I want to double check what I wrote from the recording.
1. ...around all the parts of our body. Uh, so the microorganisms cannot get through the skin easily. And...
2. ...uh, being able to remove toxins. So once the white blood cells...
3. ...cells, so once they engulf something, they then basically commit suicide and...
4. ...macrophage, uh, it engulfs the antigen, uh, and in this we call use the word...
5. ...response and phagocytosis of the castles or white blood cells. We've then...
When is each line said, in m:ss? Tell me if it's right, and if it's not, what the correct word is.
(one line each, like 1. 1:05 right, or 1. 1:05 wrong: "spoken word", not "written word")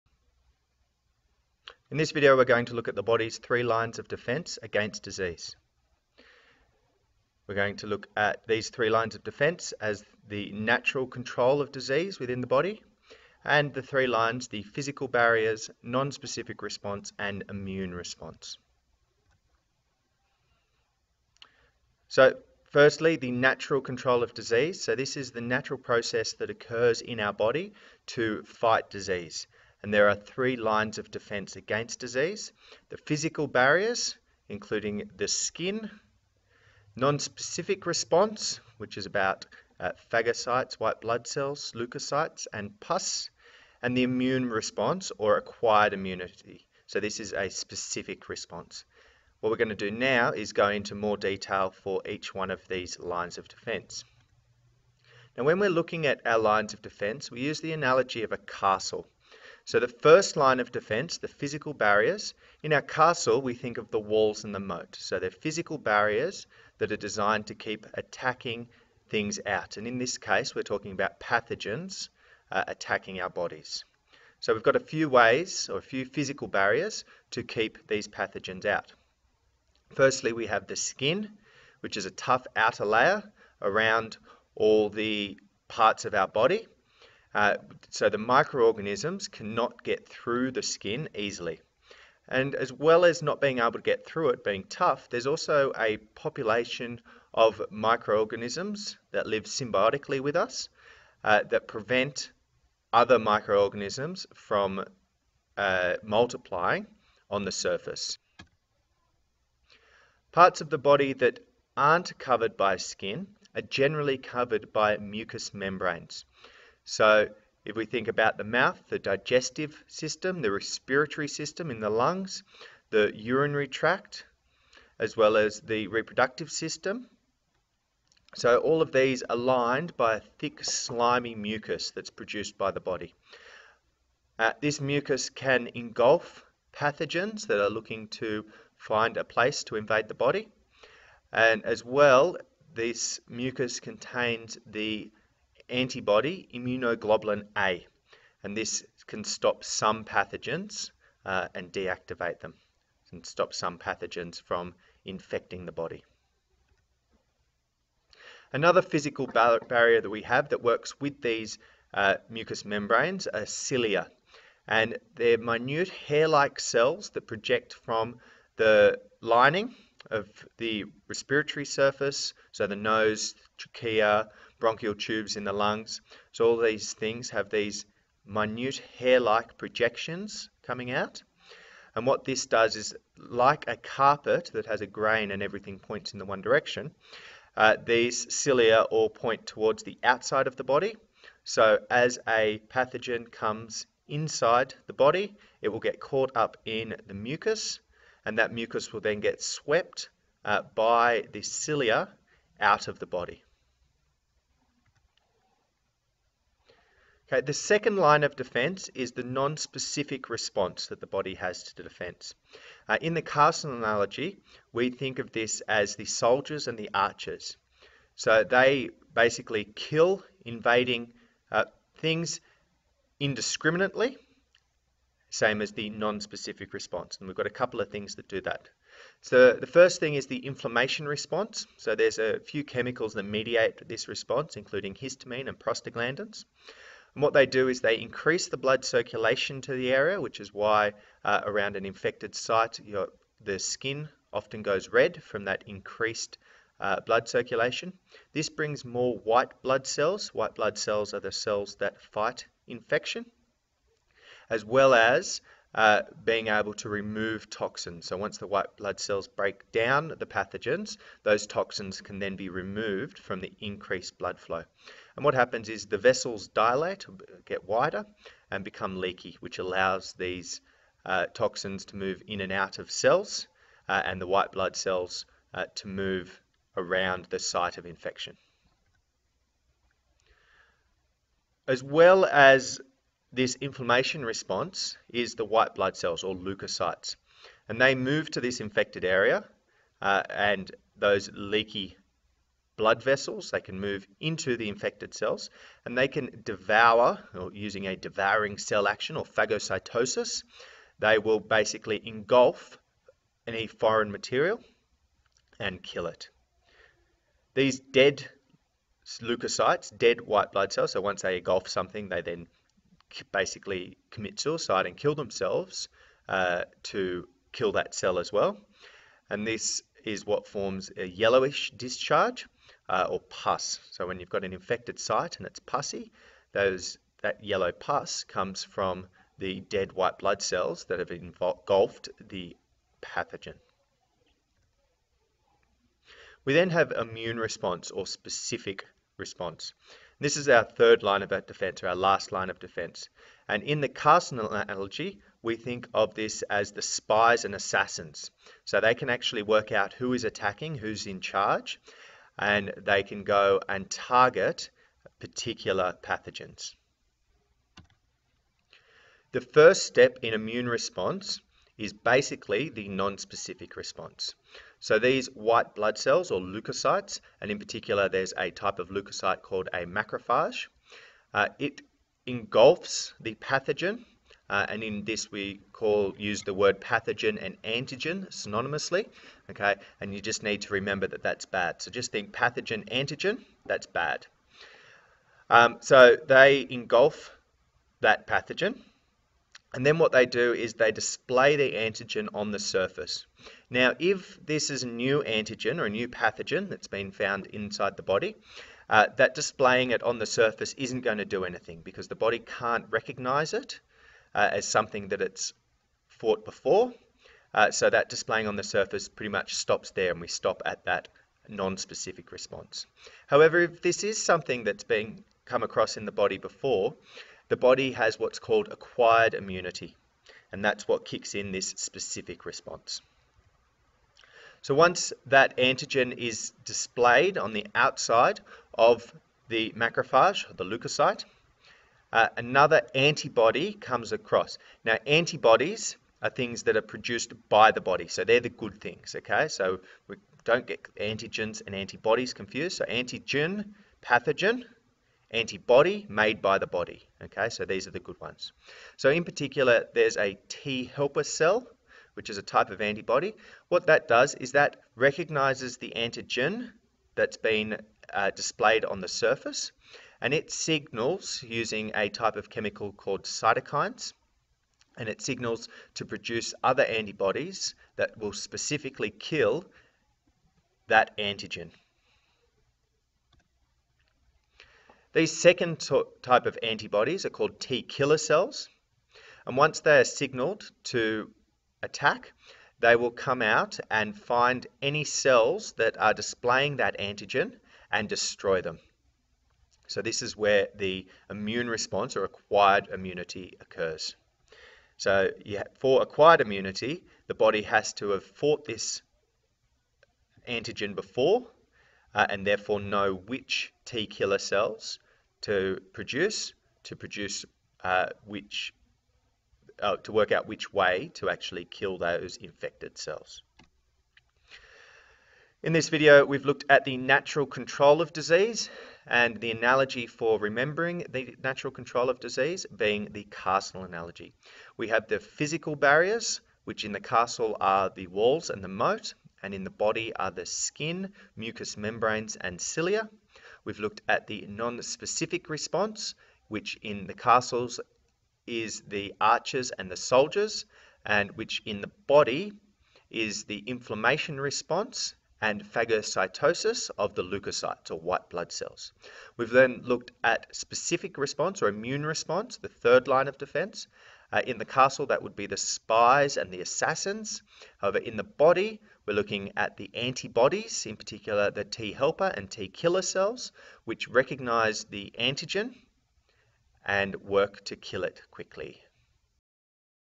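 1. 1:23 right
2. 4:15 right
3. 5:10 right
4. 6:09 wrong: "pathogen", not "antigen"
5. 9:04 wrong: "leukocytes", not "castles".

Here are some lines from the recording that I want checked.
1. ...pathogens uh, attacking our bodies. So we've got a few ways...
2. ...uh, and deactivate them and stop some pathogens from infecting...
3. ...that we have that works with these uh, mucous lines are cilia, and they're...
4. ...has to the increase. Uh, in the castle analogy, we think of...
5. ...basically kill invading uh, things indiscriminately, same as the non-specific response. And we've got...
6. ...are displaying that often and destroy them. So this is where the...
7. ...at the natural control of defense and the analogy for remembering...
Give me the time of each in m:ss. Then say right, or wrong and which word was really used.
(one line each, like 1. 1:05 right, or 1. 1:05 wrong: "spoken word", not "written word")
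1. 1:11 right
2. 2:31 right
3. 2:40 wrong: "membranes", not "lines"
4. 3:31 wrong: "defense", not "increase"
5. 3:39 right
6. 8:05 wrong: "antigen", not "often"
7. 8:36 wrong: "disease", not "defense".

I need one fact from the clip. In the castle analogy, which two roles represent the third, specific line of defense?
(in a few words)
spies and assassins.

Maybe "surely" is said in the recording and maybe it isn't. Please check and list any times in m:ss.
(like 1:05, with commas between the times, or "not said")
not said.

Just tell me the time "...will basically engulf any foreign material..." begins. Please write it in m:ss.
5:01.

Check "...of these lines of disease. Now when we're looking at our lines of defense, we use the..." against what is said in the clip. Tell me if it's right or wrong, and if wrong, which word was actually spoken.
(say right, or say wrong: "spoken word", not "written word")
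wrong: "defense", not "disease".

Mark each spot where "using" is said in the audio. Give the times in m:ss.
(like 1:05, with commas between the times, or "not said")
4:57, 7:41.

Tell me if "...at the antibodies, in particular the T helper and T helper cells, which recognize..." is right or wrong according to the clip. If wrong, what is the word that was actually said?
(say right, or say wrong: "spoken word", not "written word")
wrong: "killer", not "helper".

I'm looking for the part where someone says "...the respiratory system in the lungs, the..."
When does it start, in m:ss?
2:00.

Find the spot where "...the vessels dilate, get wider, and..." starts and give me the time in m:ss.
4:25.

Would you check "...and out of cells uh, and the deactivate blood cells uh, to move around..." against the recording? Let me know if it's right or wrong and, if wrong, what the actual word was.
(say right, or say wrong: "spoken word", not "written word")
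wrong: "white", not "deactivate".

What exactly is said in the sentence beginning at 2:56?
So all these things have these minute hair-like projections coming out.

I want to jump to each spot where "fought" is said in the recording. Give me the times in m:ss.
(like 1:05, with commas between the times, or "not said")
6:46, 8:18.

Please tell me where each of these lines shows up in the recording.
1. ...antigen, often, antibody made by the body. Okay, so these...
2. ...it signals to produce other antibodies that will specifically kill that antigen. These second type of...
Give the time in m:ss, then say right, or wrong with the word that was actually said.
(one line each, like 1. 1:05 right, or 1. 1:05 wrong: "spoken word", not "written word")
1. 7:22 wrong: "pathogen", not "often"
2. 7:45 right.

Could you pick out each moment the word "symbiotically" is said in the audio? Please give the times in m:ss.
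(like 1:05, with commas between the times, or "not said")
1:39.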